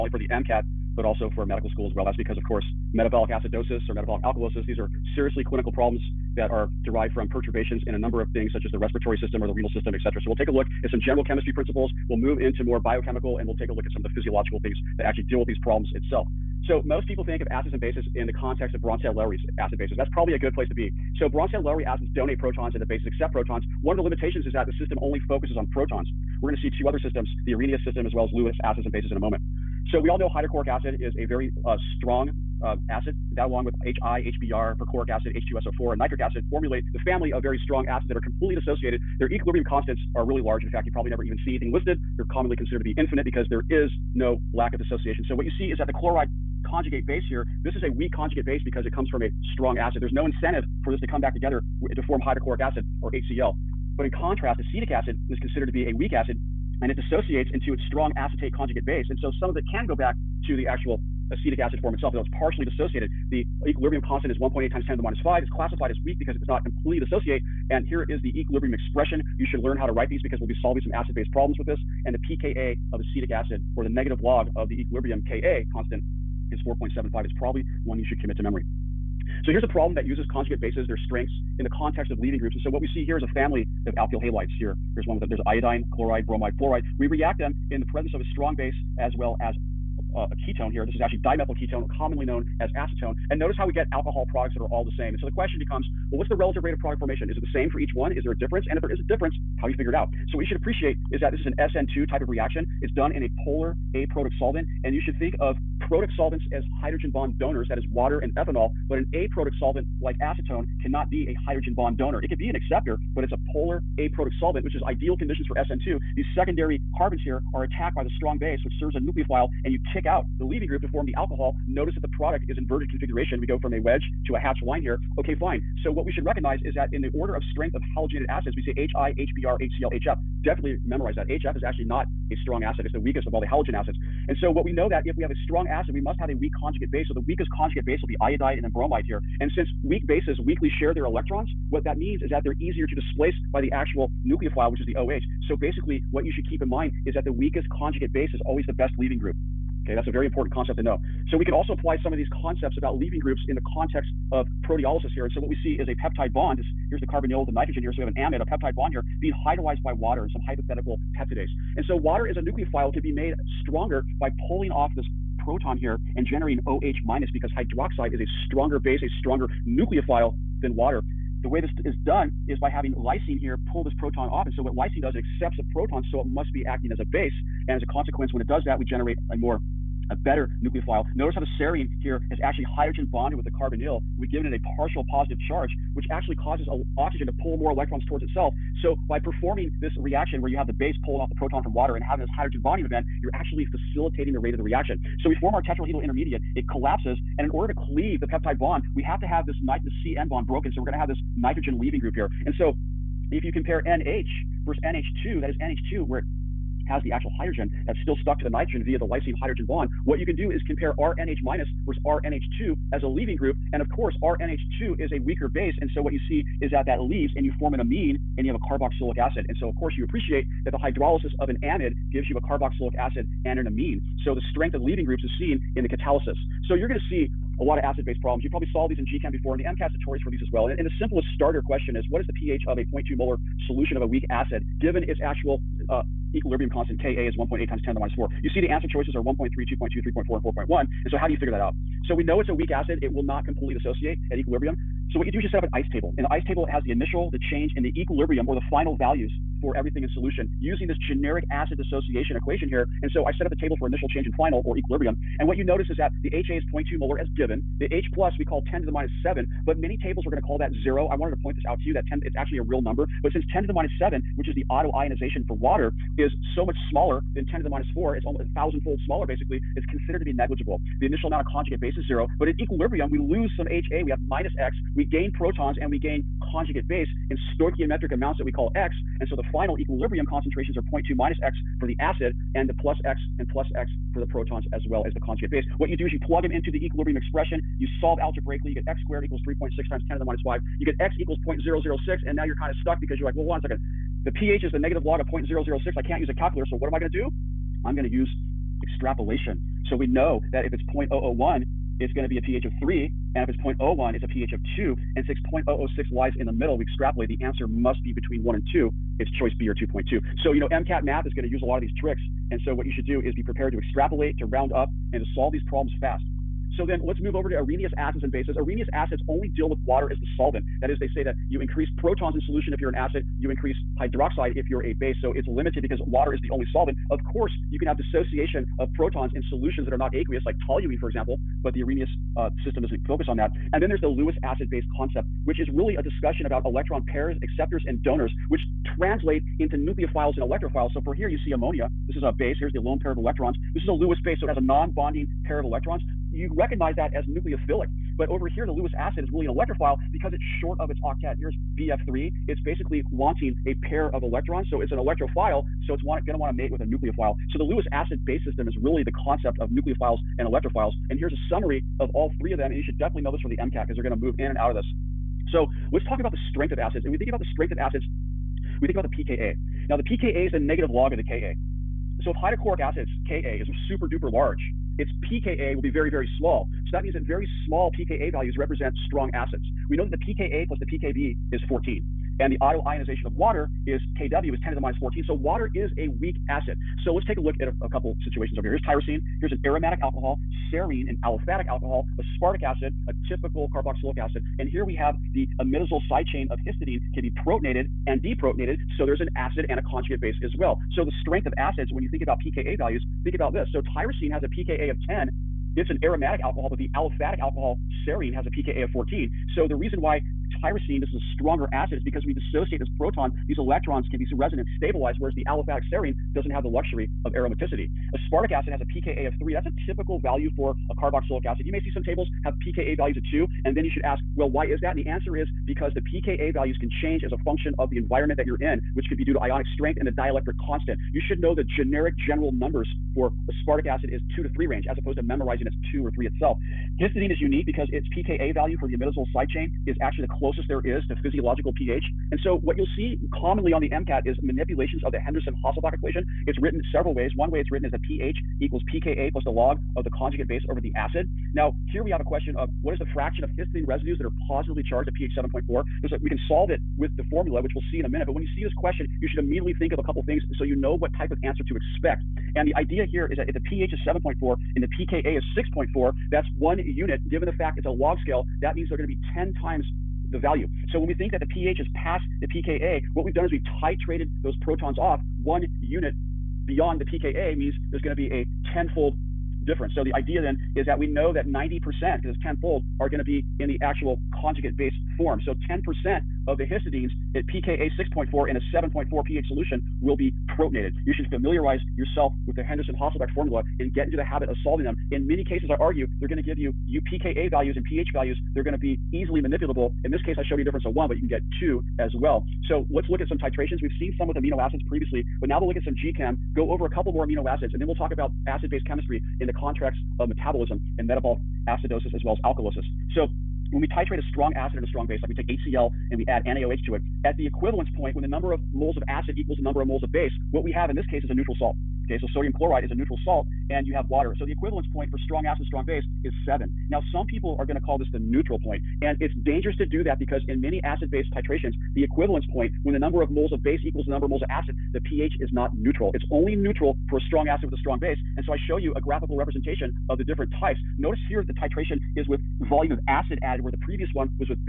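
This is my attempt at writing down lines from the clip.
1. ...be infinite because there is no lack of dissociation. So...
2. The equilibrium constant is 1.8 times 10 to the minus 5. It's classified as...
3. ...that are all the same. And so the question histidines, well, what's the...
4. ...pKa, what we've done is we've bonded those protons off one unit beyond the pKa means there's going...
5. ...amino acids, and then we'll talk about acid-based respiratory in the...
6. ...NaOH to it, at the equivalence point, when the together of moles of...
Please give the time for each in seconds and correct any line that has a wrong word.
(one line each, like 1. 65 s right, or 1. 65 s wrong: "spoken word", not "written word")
1. 42 s right
2. 63 s right
3. 94 s wrong: "becomes", not "histidines"
4. 472 s wrong: "titrated", not "bonded"
5. 507 s wrong: "chemistry", not "respiratory"
6. 516 s wrong: "number", not "together".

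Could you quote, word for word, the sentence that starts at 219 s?
And so of course you appreciate that the hydrolysis of an amide gives you a carboxylic acid and an amine.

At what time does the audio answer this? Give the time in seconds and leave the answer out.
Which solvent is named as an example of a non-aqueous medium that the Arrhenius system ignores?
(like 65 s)
330 s.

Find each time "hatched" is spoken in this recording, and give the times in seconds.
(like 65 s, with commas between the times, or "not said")
124 s.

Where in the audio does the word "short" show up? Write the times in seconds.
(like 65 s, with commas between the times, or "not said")
350 s.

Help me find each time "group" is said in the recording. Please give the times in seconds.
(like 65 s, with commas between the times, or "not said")
82 s, 120 s, 149 s, 153 s, 201 s, 213 s, 225 s.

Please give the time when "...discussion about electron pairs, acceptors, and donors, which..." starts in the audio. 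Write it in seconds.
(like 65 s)
336 s.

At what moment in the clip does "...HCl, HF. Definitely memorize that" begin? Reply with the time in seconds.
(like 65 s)
129 s.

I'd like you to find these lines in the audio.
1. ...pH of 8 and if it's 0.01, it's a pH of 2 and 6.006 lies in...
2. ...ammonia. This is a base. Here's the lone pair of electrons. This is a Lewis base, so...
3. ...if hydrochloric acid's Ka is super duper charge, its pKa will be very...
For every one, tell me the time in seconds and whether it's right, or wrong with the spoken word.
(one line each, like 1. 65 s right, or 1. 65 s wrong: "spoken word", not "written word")
1. 302 s wrong: "3", not "8"
2. 341 s right
3. 372 s wrong: "large", not "charge".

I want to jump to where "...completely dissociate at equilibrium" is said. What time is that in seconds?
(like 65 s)
243 s.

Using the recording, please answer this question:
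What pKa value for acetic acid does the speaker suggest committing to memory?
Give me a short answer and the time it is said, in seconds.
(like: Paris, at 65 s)
4.75, at 76 s.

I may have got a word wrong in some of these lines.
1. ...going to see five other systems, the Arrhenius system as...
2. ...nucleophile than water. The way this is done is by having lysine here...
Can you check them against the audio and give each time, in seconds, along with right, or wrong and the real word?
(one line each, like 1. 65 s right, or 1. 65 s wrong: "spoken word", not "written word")
1. 26 s wrong: "two", not "five"
2. 169 s right.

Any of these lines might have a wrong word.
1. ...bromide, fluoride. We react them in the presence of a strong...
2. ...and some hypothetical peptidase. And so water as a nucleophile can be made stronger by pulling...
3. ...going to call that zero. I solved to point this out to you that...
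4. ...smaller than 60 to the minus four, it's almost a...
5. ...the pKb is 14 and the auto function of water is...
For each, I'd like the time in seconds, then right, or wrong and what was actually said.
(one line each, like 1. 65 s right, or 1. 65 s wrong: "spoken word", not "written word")
1. 86 s right
2. 160 s right
3. 260 s wrong: "wanted", not "solved"
4. 266 s wrong: "10", not "60"
5. 380 s wrong: "ionization", not "function".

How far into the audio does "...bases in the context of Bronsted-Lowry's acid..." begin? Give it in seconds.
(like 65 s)
17 s.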